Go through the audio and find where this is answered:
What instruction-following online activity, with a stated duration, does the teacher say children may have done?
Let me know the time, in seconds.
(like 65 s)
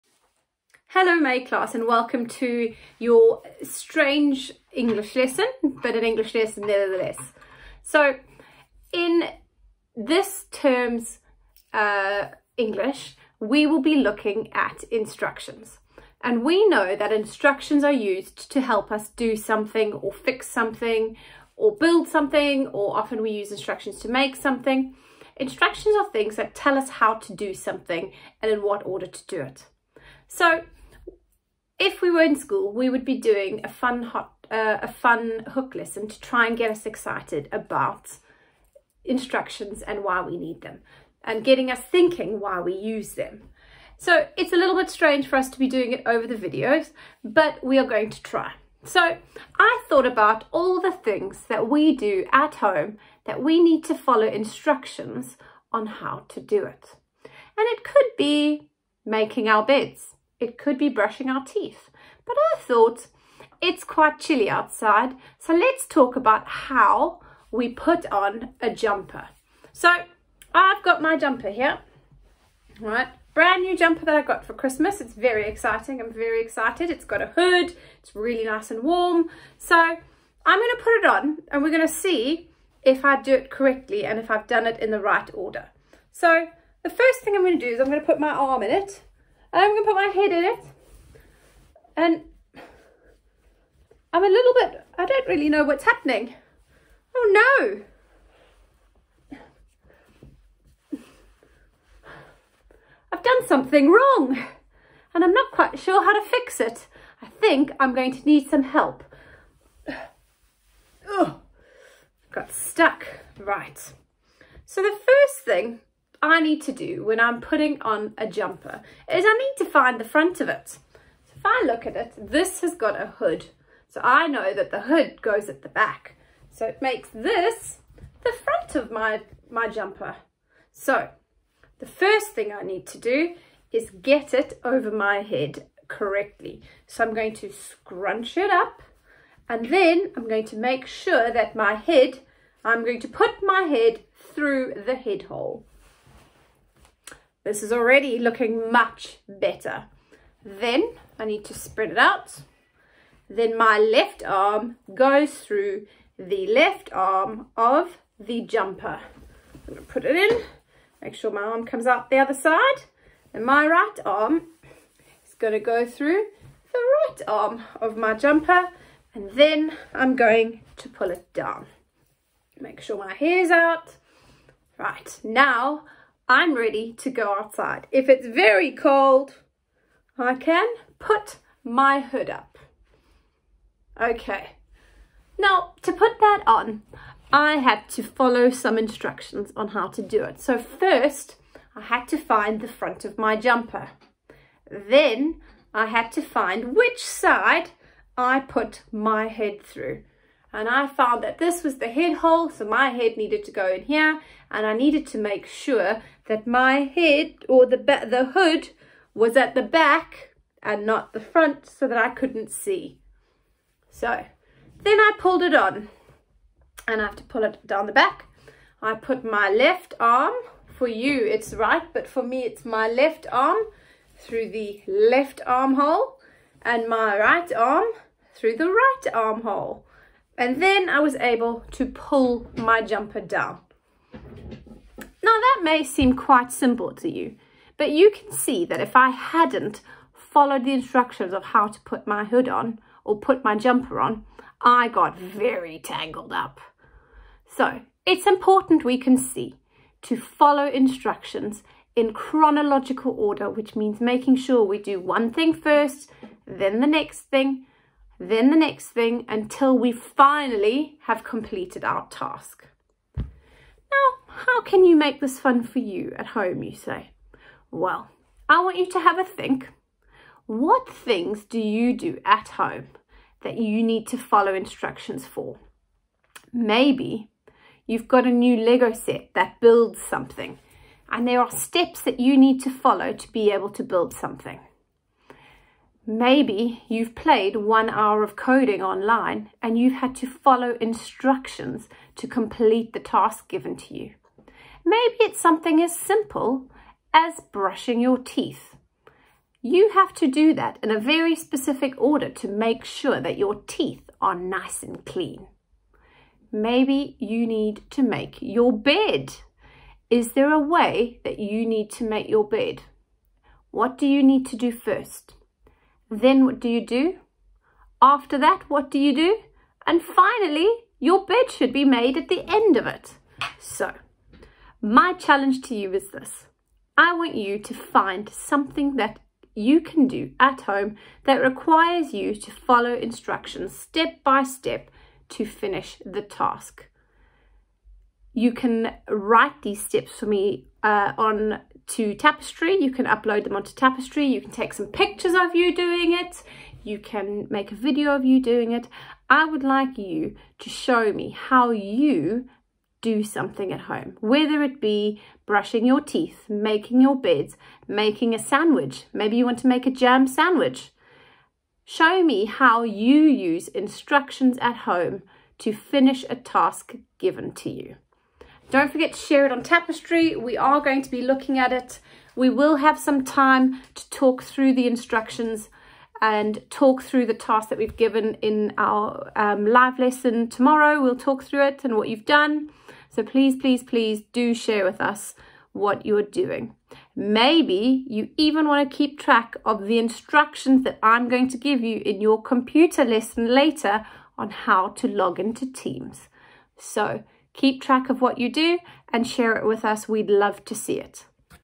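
287 s.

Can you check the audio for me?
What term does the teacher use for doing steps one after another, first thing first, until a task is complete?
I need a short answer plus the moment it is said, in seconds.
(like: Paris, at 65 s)
Chronological order, at 252 s.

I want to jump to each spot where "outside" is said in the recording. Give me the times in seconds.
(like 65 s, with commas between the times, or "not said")
64 s, 177 s.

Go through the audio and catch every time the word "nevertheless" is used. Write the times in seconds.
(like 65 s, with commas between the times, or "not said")
6 s.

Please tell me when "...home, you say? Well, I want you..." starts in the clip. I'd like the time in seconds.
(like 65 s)
266 s.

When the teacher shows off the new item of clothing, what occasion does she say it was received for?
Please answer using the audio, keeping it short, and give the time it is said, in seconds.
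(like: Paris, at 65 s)
Christmas, at 74 s.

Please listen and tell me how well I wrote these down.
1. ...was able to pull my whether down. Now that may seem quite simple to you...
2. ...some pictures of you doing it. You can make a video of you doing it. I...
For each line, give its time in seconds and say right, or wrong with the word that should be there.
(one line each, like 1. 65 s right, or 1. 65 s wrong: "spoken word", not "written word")
1. 230 s wrong: "jumper", not "whether"
2. 344 s right.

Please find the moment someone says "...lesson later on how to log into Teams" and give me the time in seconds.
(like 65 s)
393 s.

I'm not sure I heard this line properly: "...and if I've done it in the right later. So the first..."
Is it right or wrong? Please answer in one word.
wrong.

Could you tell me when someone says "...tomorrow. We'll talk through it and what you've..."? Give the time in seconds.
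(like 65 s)
380 s.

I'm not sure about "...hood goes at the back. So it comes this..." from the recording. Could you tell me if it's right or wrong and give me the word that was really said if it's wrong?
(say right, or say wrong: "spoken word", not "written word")
wrong: "makes", not "comes".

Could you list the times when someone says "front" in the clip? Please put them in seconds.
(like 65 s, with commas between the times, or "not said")
120 s, 128 s, 192 s, 211 s.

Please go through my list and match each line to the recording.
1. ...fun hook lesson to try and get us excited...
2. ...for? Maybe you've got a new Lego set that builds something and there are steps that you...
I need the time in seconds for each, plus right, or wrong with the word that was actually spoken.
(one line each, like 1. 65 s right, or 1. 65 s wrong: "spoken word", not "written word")
1. 34 s right
2. 275 s right.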